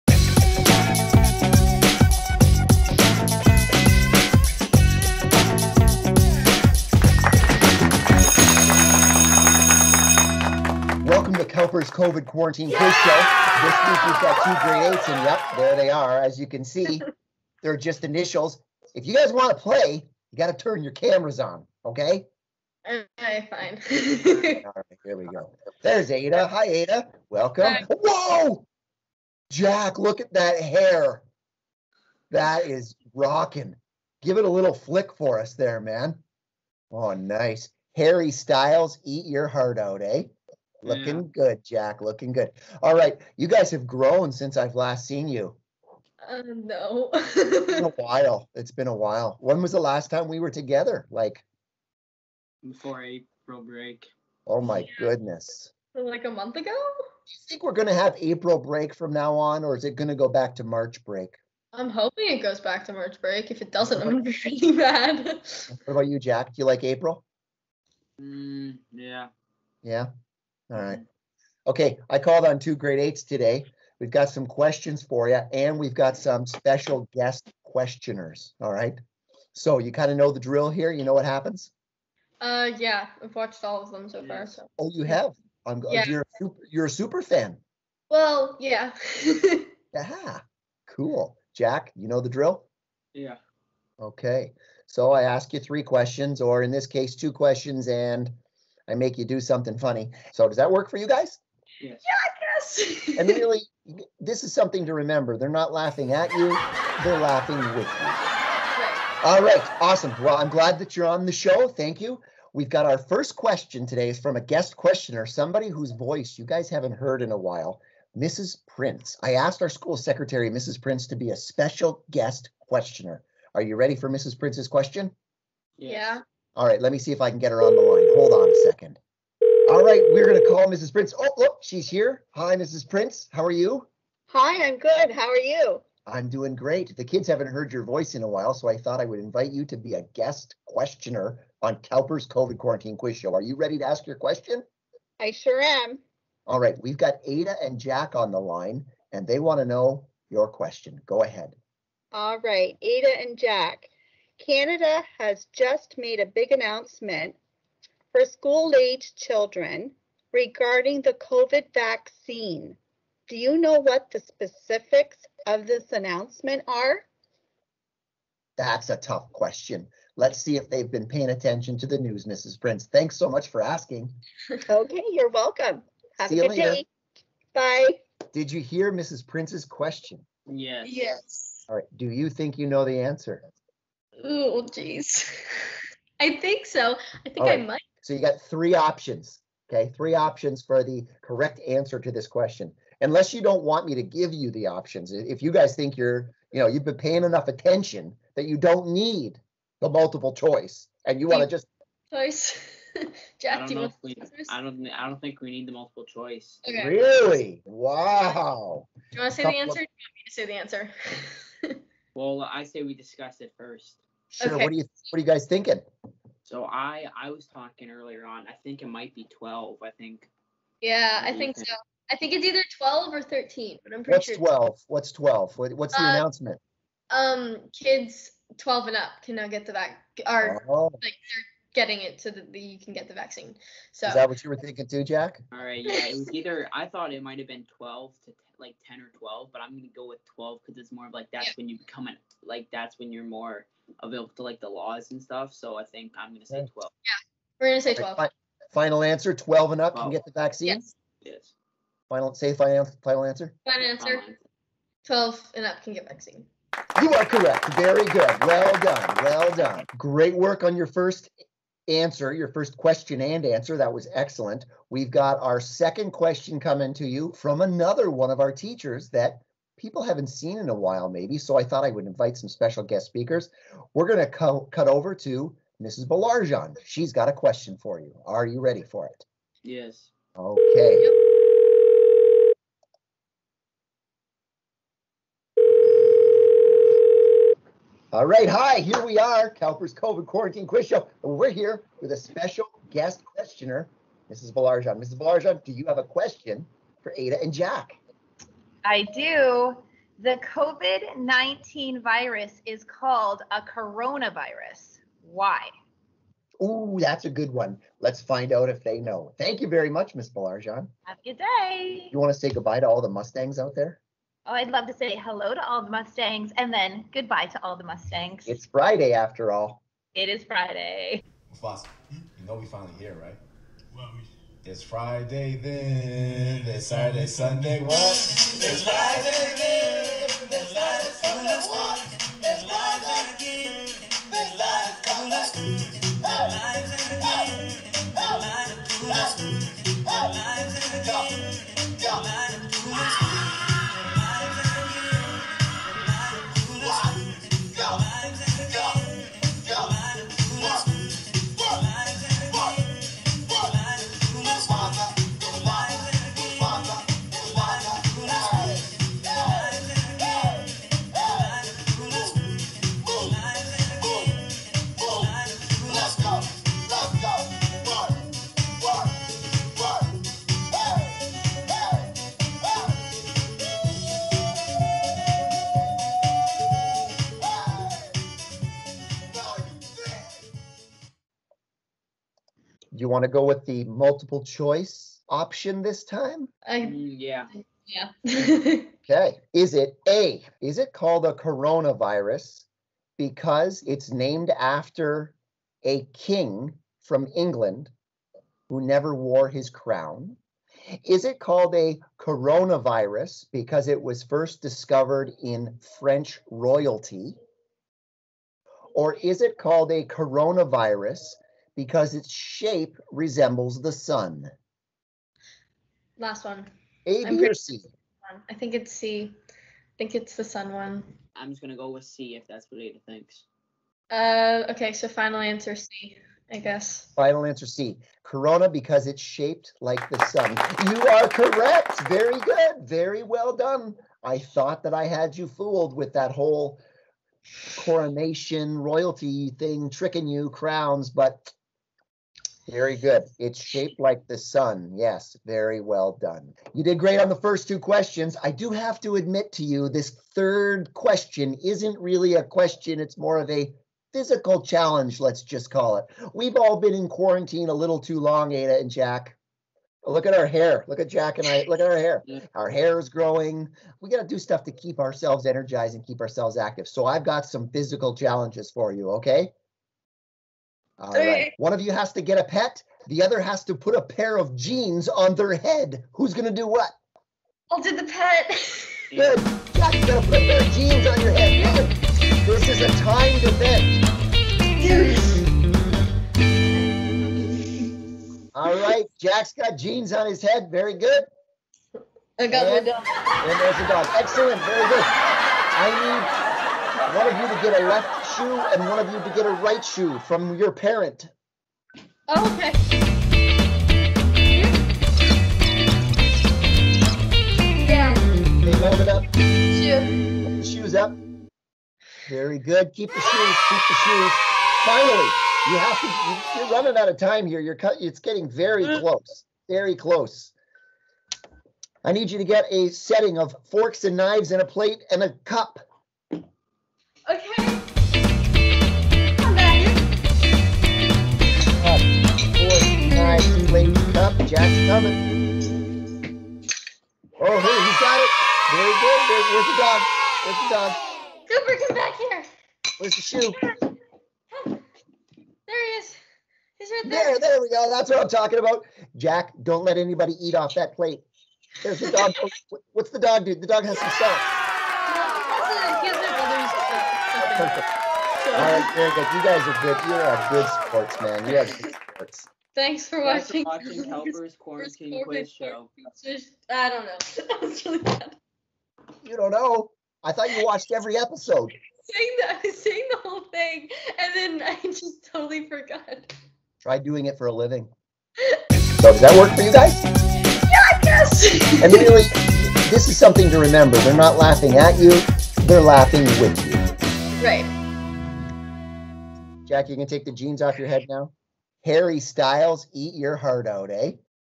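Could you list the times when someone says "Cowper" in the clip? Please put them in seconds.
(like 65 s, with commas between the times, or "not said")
11 s, 141 s, 289 s, 564 s.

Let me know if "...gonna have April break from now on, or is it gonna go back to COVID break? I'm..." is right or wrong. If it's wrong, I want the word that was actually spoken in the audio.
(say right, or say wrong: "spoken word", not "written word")
wrong: "March", not "COVID".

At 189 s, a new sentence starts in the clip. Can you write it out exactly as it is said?
Three options for the correct answer to this question.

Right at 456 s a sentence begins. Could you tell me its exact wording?
We've all been in quarantine a little too long, Ada and Jack.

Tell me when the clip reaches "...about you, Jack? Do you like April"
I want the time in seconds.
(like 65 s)
65 s.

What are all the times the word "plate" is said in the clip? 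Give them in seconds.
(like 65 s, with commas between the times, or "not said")
524 s, 550 s.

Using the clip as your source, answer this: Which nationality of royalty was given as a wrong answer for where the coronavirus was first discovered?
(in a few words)
French.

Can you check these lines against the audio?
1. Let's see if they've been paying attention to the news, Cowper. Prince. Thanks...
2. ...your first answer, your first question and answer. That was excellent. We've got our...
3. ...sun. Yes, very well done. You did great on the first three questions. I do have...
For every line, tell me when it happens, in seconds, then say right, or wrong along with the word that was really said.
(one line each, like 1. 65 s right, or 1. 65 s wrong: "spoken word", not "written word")
1. 170 s wrong: "Mrs", not "Cowper"
2. 260 s right
3. 444 s wrong: "two", not "three".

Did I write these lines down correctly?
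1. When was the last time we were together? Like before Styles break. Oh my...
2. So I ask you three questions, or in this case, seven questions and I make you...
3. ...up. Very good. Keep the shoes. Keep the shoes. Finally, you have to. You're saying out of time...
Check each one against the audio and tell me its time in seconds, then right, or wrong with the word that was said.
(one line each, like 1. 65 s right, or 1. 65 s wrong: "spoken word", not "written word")
1. 49 s wrong: "April", not "Styles"
2. 94 s wrong: "two", not "seven"
3. 510 s wrong: "running", not "saying".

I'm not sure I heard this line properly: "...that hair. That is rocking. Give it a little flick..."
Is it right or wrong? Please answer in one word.
right.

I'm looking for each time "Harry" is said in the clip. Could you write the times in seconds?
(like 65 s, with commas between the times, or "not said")
37 s, 591 s.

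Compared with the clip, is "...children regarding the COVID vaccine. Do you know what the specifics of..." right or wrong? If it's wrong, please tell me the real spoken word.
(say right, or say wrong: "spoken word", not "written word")
right.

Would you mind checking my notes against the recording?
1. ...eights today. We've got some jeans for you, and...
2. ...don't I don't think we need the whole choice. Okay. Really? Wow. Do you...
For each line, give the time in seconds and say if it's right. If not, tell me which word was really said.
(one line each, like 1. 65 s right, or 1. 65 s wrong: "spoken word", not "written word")
1. 72 s wrong: "questions", not "jeans"
2. 204 s wrong: "multiple", not "whole".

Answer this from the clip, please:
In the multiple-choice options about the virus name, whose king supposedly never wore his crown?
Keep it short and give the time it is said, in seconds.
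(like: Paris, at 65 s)
England, at 397 s.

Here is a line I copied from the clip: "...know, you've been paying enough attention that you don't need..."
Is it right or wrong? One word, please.
right.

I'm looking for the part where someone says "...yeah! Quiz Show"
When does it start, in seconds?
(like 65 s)
12 s.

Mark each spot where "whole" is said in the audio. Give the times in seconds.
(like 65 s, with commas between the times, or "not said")
436 s, 573 s.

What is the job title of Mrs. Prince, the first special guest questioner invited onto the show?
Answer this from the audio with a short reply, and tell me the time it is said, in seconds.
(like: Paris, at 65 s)
school secretary, at 119 s.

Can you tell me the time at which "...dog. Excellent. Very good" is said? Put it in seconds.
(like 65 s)
493 s.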